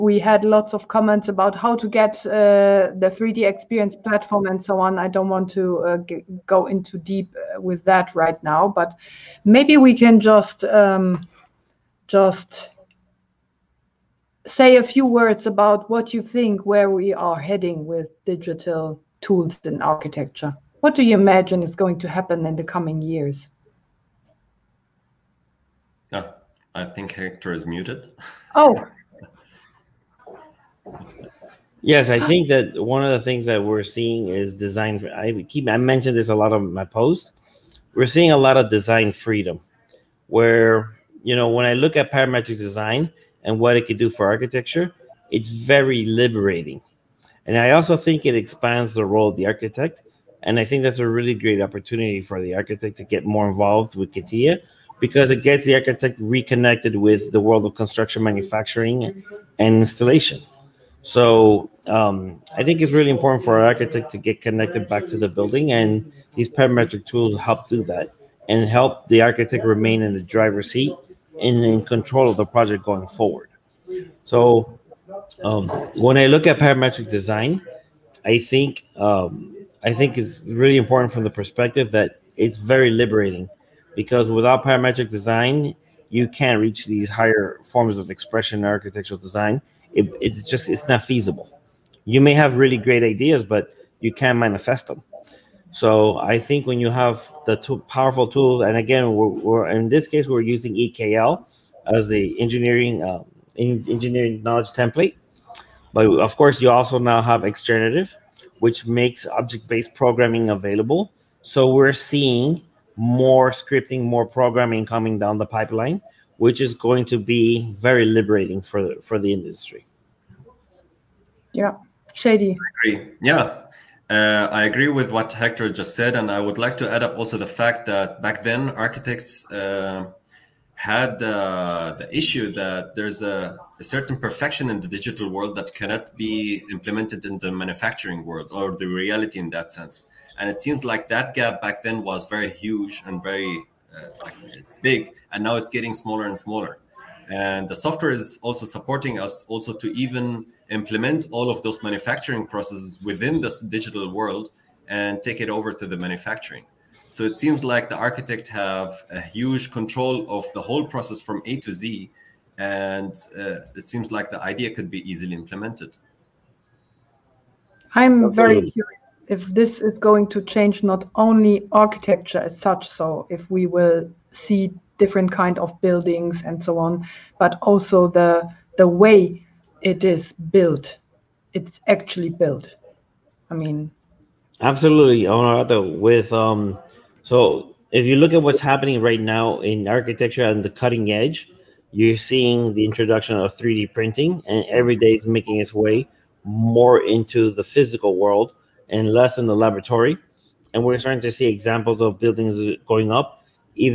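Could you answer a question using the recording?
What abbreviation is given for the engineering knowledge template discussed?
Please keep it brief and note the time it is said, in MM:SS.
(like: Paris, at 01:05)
EKL, at 01:40.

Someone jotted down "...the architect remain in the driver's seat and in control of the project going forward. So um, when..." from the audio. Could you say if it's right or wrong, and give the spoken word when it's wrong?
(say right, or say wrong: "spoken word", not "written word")
right.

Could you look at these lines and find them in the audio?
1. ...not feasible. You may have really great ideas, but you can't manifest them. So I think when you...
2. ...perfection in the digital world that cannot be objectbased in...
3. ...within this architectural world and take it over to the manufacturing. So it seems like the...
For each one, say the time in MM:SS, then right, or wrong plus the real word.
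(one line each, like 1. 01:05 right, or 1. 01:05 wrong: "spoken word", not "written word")
1. 01:30 right
2. 02:14 wrong: "implemented", not "objectbased"
3. 02:33 wrong: "digital", not "architectural".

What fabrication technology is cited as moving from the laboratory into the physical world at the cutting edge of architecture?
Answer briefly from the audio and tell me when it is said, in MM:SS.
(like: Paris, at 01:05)
3D printing, at 03:13.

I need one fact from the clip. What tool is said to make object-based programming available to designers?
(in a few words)
Externative.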